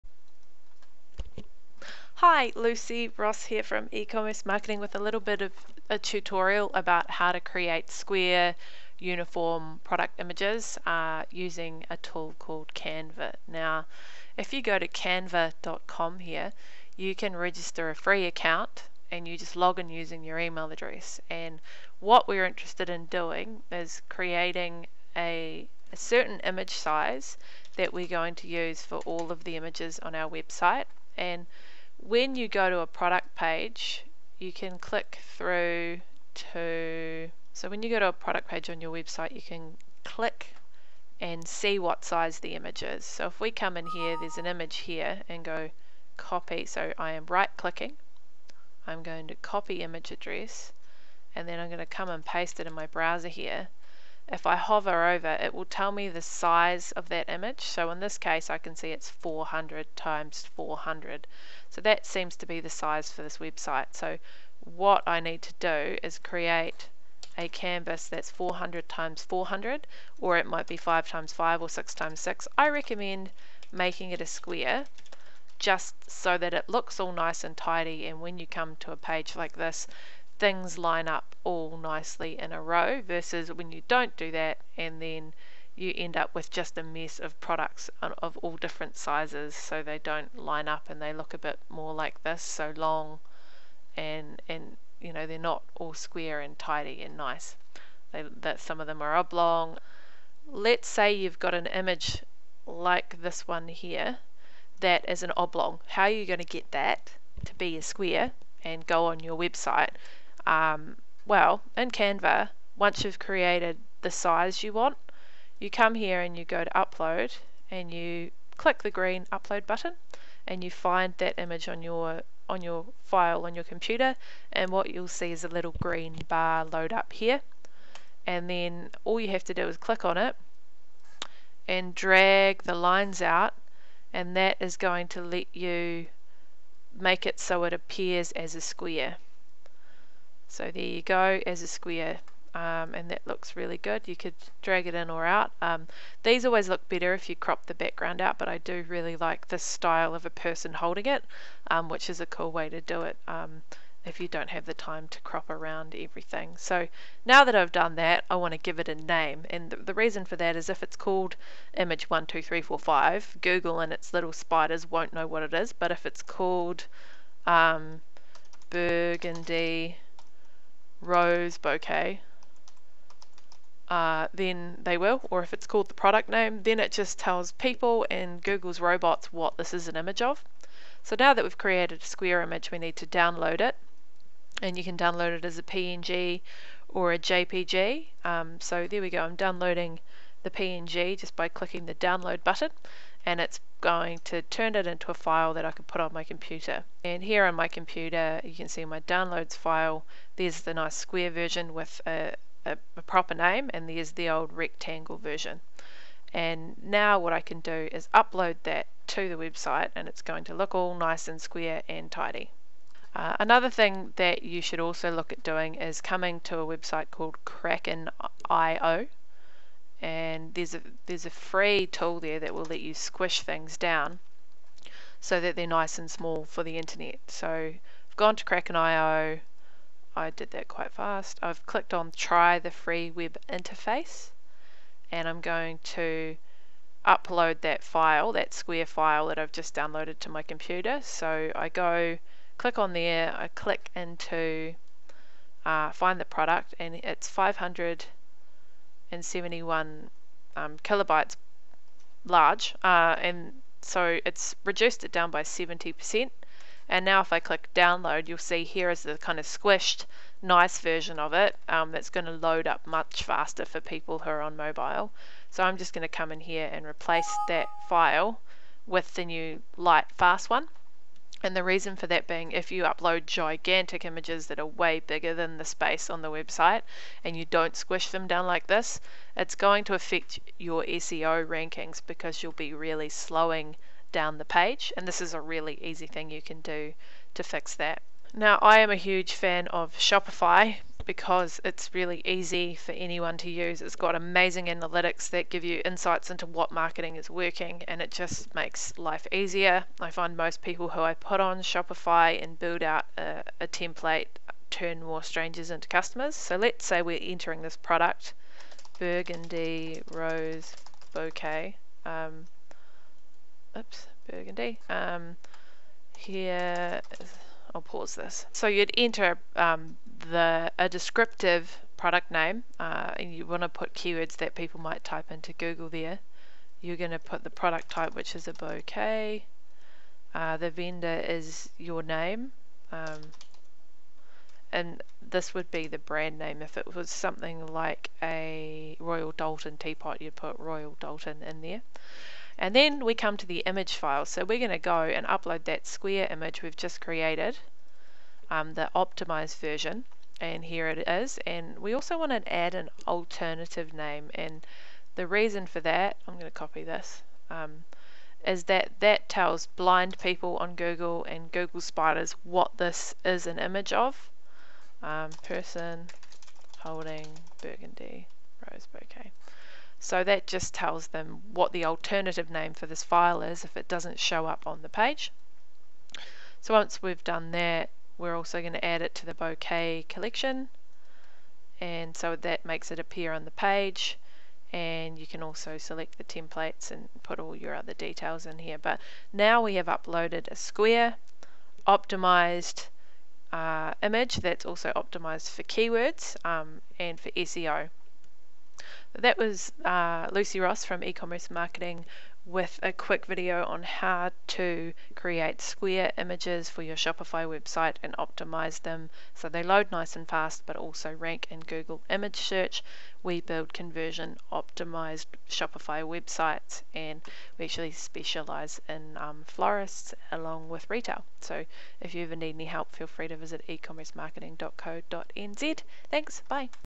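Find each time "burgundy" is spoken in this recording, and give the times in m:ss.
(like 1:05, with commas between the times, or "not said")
2:48, 5:08, 5:14, 6:07.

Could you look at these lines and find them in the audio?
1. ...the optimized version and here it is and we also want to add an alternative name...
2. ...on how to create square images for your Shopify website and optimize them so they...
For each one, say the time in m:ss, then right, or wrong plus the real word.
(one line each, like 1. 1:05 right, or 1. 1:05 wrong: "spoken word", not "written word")
1. 5:48 right
2. 6:43 right.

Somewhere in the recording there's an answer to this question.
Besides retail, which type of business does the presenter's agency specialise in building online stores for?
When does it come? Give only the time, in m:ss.
6:59.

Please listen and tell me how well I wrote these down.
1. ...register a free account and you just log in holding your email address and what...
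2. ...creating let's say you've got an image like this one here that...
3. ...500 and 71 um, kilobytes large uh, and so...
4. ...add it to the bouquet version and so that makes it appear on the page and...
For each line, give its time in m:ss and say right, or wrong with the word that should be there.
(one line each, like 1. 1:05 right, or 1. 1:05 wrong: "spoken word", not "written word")
1. 0:17 wrong: "using", not "holding"
2. 1:39 wrong: "oblong", not "creating"
3. 4:07 right
4. 6:18 wrong: "collection", not "version".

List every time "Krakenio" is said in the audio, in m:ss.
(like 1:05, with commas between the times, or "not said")
3:37, 3:48.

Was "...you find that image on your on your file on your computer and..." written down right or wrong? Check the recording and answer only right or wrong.
right.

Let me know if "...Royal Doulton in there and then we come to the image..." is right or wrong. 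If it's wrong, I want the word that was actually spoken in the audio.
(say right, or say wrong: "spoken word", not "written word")
right.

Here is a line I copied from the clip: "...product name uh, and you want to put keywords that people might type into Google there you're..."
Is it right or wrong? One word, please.
right.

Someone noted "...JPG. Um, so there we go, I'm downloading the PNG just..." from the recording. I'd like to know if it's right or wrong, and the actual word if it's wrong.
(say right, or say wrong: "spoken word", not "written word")
right.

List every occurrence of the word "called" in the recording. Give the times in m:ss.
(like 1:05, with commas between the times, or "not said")
0:12, 2:40, 2:46, 2:55, 3:37.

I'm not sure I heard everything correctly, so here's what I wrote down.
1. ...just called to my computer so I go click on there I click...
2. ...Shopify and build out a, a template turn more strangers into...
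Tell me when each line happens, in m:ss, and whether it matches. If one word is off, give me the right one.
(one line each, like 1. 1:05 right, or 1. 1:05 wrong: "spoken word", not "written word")
1. 3:59 wrong: "downloaded", not "called"
2. 5:01 right.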